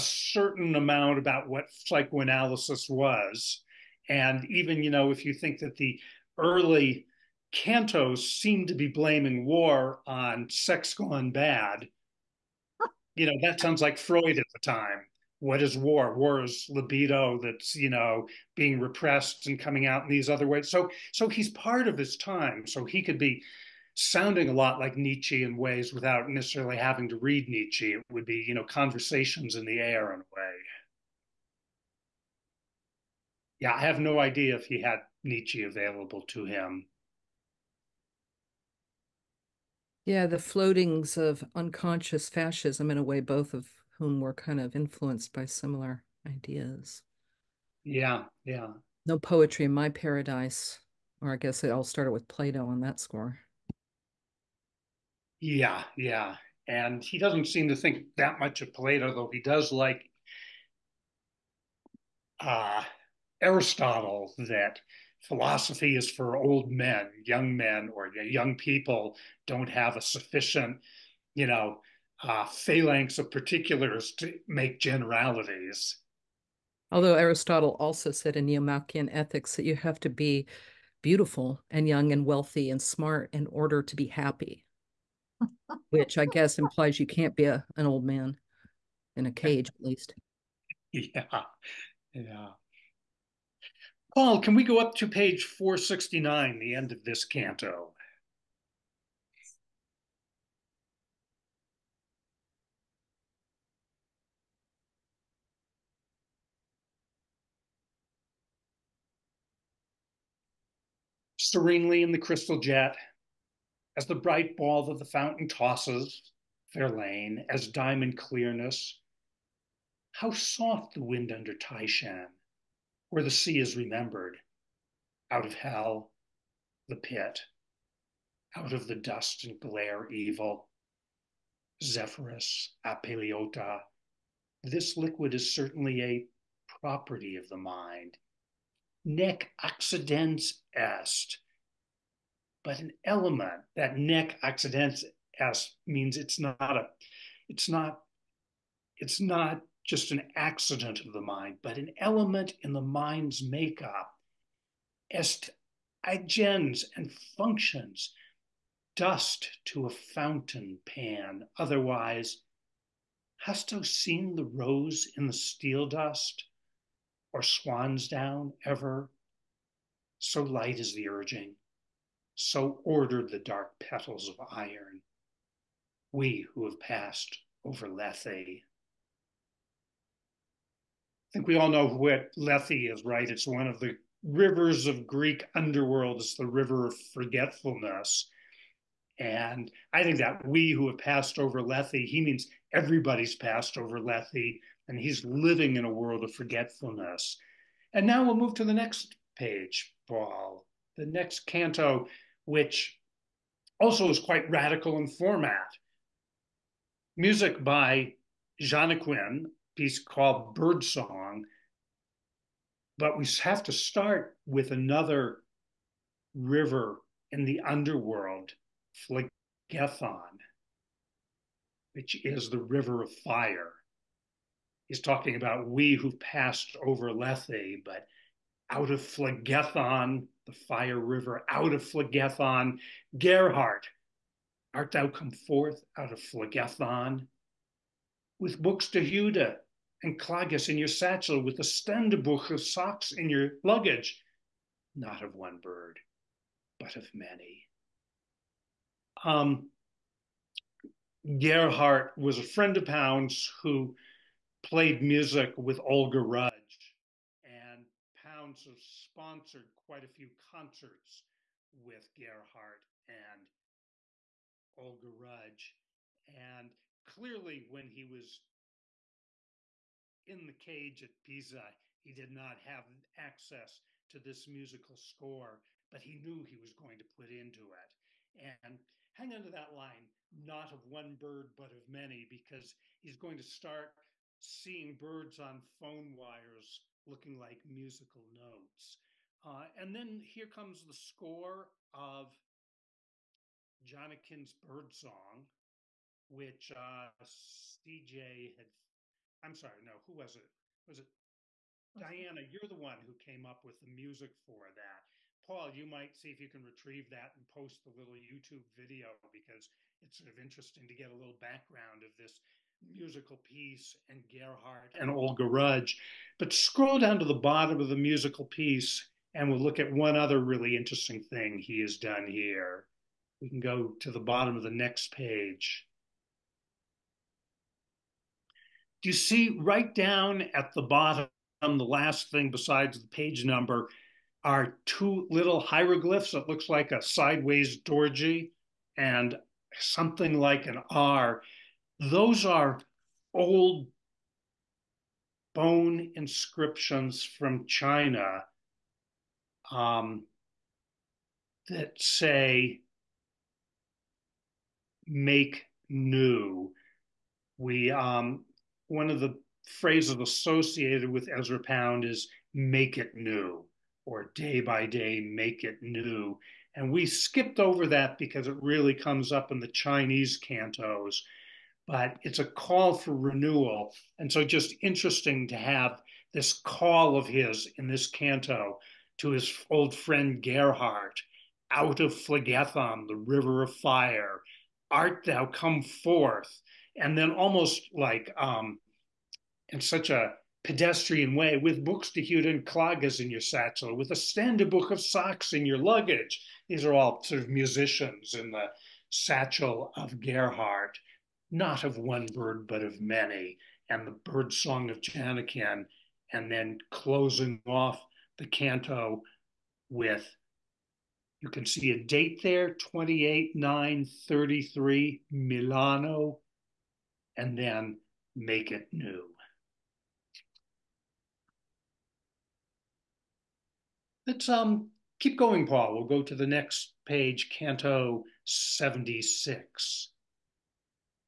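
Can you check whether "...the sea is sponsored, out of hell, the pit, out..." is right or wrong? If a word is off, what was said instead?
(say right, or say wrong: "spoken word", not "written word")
wrong: "remembered", not "sponsored".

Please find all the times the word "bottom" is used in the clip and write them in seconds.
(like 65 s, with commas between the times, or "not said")
317 s, 324 s, 330 s.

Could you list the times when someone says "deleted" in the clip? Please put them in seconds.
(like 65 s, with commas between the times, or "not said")
not said.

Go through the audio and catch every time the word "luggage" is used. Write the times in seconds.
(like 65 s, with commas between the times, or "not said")
243 s, 395 s.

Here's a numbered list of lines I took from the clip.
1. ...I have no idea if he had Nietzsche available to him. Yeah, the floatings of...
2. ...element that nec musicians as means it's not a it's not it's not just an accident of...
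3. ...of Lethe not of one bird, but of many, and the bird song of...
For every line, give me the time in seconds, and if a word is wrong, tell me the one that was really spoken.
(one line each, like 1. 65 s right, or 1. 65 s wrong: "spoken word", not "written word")
1. 33 s right
2. 143 s wrong: "accidens", not "musicians"
3. 399 s wrong: "Gerhardt", not "Lethe".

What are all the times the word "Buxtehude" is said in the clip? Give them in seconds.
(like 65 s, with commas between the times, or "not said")
238 s, 391 s.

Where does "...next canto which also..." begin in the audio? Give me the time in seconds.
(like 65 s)
201 s.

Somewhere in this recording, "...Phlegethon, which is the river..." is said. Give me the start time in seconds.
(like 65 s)
219 s.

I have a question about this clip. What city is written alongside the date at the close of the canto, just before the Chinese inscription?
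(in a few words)
Milano.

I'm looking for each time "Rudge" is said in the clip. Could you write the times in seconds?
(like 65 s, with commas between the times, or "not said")
256 s, 265 s, 315 s.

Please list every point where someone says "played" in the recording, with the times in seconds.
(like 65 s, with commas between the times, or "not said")
254 s.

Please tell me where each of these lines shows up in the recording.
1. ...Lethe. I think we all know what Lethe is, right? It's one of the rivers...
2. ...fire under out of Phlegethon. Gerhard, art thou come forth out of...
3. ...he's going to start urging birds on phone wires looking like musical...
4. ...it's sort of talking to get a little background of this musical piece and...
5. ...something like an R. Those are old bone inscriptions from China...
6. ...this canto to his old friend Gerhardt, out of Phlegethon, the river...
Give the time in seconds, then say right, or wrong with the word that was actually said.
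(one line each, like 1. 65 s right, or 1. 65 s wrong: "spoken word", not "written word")
1. 177 s right
2. 230 s wrong: "river", not "under"
3. 283 s wrong: "seeing", not "urging"
4. 310 s wrong: "interesting", not "talking"
5. 339 s right
6. 377 s right.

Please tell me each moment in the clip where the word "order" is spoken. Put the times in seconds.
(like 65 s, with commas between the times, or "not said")
83 s, 172 s.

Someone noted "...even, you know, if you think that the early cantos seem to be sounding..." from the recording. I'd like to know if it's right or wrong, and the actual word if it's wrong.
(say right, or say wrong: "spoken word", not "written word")
wrong: "blaming", not "sounding".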